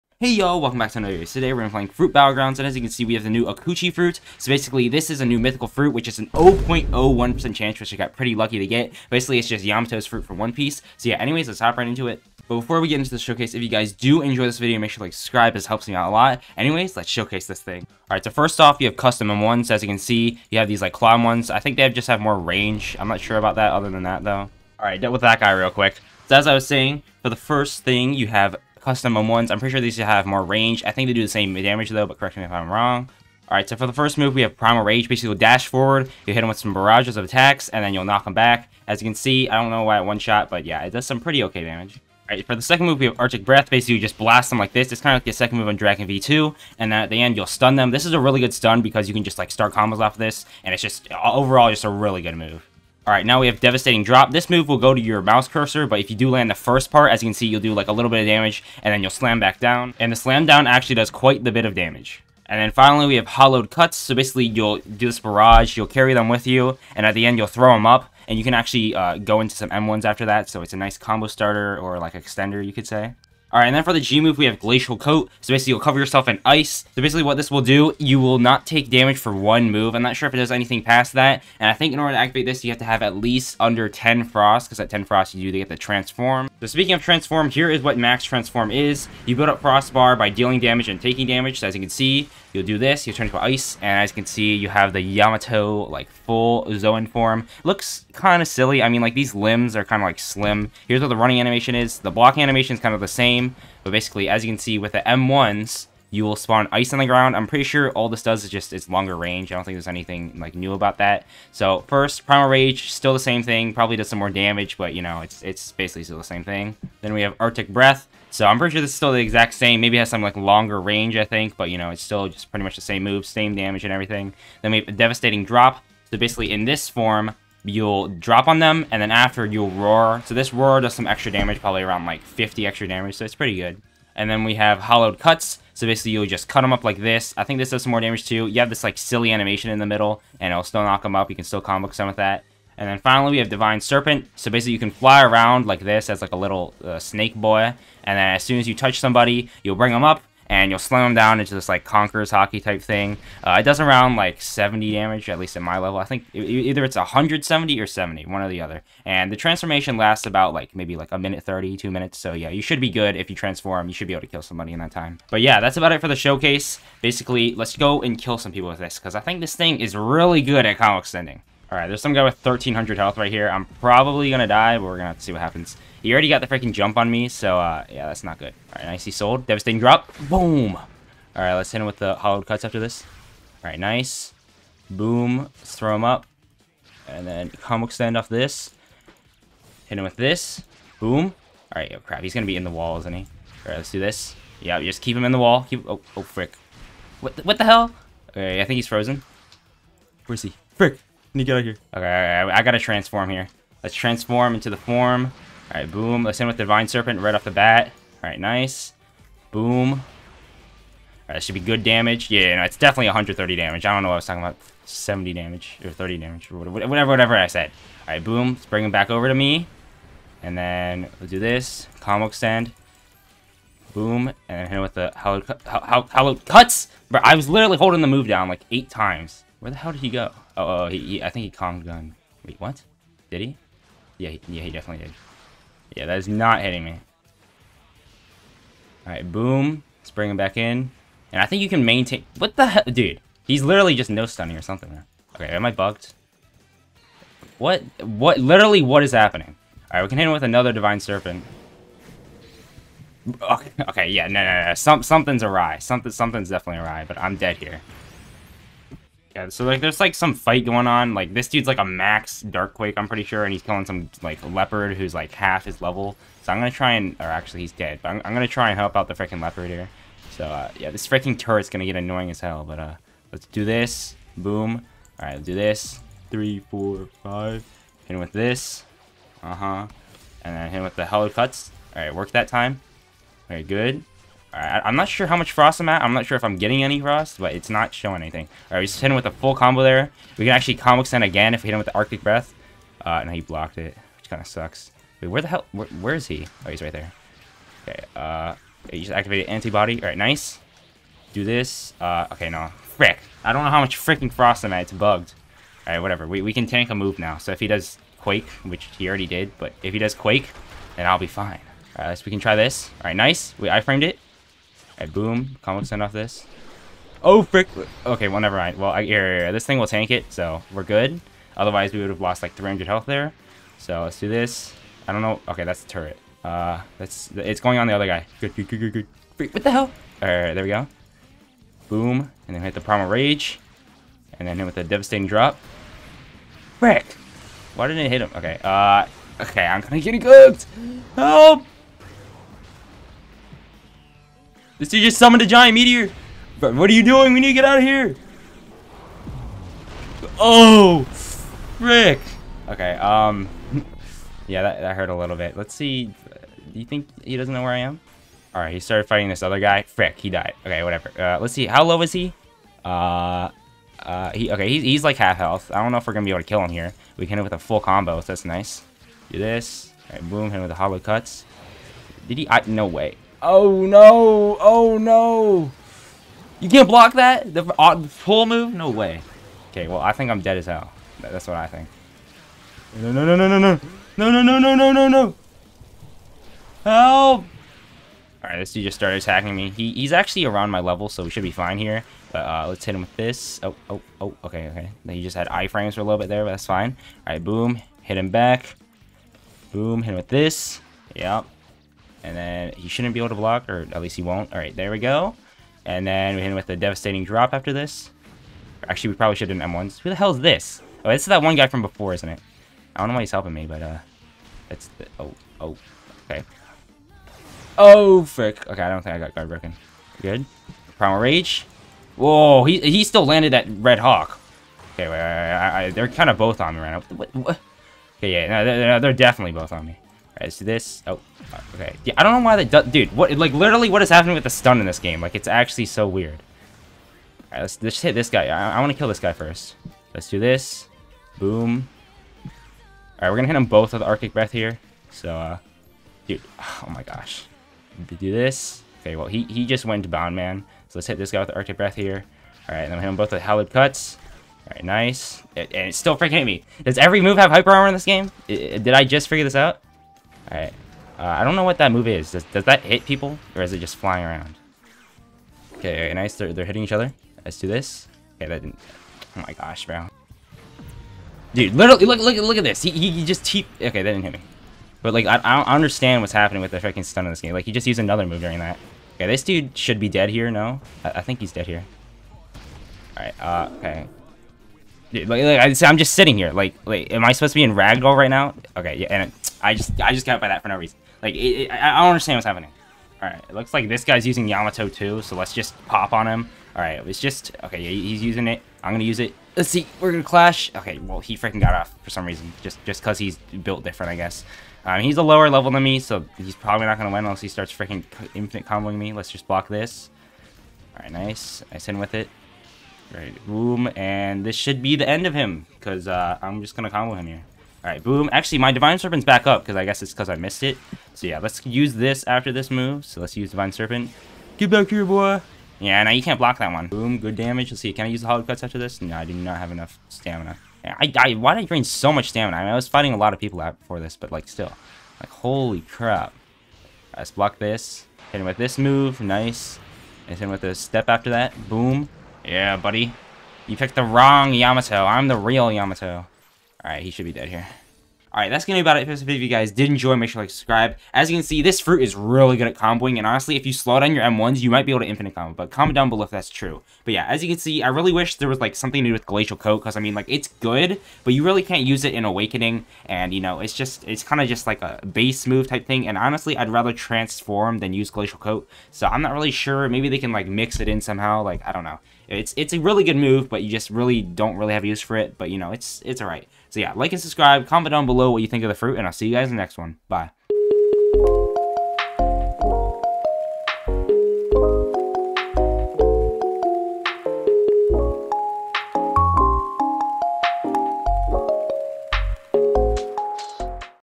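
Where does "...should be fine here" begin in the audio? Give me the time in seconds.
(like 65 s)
391 s.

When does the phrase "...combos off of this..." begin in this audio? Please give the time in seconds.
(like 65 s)
49 s.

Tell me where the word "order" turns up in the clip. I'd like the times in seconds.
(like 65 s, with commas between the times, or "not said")
81 s.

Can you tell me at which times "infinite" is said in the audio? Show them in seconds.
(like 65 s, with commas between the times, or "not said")
508 s, 555 s.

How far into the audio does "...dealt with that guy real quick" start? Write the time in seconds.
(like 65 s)
25 s.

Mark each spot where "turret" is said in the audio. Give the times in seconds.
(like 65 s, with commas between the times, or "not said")
271 s, 325 s.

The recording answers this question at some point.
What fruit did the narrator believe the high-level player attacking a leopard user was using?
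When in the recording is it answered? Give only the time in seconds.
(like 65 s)
262 s.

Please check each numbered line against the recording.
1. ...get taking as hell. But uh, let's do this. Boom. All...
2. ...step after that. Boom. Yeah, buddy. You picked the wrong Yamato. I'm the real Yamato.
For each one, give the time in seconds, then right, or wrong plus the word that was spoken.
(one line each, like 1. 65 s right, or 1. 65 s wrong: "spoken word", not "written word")
1. 271 s wrong: "annoying", not "taking"
2. 540 s right.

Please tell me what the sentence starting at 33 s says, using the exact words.
Alright, so for the first move, we have Primal Rage.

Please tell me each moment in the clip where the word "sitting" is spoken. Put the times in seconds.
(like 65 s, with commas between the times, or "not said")
486 s.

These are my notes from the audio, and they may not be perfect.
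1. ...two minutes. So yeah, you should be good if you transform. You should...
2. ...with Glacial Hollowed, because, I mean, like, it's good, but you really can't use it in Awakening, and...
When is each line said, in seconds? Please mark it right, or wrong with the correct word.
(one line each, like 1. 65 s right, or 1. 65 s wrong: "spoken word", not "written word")
1. 161 s right
2. 559 s wrong: "Coat", not "Hollowed".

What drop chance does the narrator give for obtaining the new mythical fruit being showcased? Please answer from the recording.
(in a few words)
0.01%.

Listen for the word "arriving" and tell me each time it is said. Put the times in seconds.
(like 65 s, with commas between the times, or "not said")
not said.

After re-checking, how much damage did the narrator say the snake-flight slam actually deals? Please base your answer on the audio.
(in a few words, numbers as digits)
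130.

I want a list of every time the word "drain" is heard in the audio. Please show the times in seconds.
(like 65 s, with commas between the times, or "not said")
531 s.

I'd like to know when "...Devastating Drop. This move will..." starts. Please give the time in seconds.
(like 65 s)
53 s.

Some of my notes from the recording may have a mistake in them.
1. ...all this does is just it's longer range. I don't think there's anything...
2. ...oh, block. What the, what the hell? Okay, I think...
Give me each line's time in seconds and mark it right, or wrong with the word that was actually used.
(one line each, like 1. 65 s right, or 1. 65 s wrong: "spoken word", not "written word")
1. 107 s right
2. 196 s wrong: "frick", not "block".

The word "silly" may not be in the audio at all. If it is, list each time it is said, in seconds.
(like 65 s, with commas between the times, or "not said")
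98 s, 138 s.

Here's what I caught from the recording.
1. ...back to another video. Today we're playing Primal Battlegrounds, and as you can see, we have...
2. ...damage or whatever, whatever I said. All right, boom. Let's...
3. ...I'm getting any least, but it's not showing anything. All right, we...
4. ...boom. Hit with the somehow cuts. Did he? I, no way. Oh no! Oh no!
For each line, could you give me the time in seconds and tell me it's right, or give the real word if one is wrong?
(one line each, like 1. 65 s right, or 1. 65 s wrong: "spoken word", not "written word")
1. 0 s wrong: "Fruit", not "Primal"
2. 216 s right
3. 286 s wrong: "frost", not "least"
4. 370 s wrong: "hollow", not "somehow".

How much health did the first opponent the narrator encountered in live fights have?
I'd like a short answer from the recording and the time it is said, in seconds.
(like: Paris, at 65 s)
1,300, at 172 s.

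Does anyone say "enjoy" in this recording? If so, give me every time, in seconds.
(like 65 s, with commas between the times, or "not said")
14 s, 549 s.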